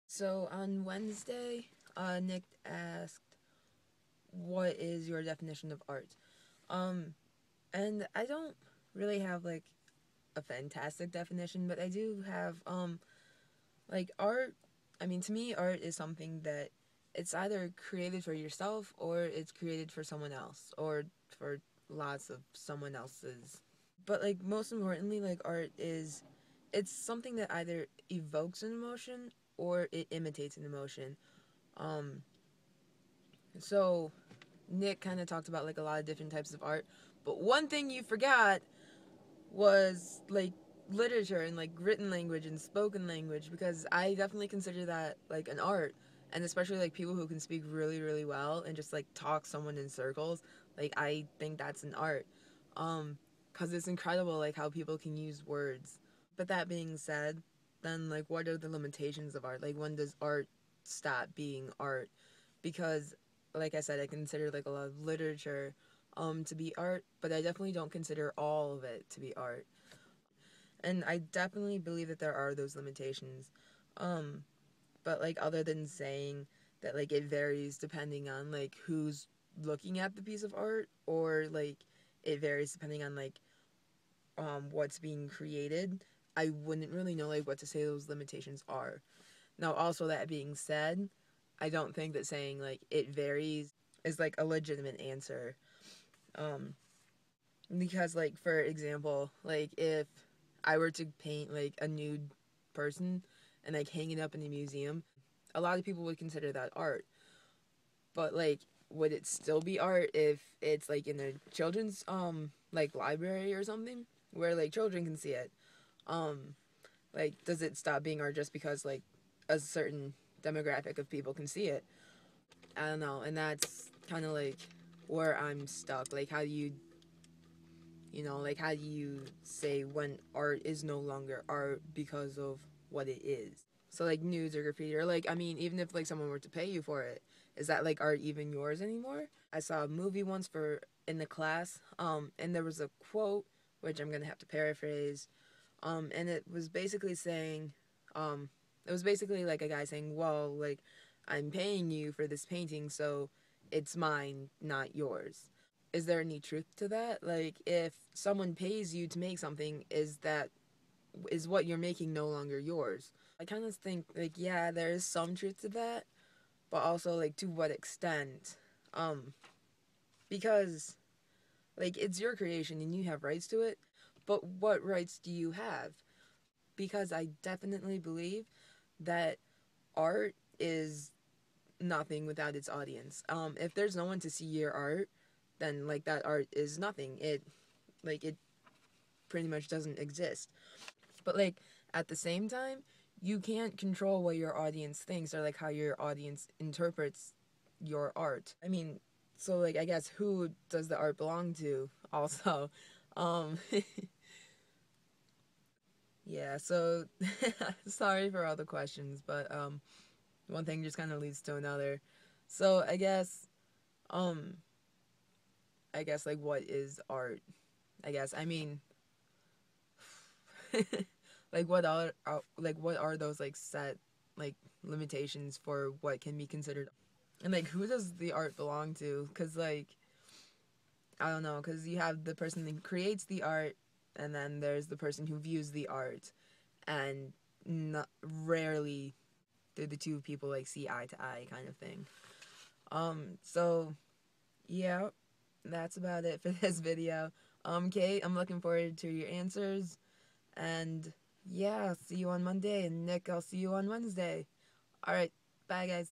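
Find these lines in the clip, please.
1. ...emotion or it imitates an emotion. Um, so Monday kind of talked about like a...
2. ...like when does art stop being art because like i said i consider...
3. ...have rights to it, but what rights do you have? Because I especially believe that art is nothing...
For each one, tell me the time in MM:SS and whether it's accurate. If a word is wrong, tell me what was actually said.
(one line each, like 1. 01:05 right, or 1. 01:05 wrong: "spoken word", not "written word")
1. 00:28 wrong: "Nick", not "Monday"
2. 00:59 right
3. 02:53 wrong: "definitely", not "especially".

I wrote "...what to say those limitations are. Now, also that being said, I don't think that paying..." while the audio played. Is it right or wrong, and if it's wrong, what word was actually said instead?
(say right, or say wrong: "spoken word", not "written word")
wrong: "saying", not "paying".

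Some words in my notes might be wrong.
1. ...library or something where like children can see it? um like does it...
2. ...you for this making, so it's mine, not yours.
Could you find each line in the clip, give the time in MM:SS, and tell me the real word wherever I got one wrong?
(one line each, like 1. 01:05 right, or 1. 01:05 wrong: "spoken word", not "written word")
1. 01:52 right
2. 02:31 wrong: "painting", not "making".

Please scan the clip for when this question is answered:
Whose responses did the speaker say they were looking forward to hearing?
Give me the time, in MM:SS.
04:07.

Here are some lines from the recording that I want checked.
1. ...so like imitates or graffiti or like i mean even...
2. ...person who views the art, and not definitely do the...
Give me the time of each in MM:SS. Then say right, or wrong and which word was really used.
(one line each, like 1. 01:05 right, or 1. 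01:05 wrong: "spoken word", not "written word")
1. 02:13 wrong: "nudes", not "imitates"
2. 03:54 wrong: "rarely", not "definitely".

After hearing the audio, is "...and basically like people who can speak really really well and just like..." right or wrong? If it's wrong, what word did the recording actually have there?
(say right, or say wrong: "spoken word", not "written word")
wrong: "especially", not "basically".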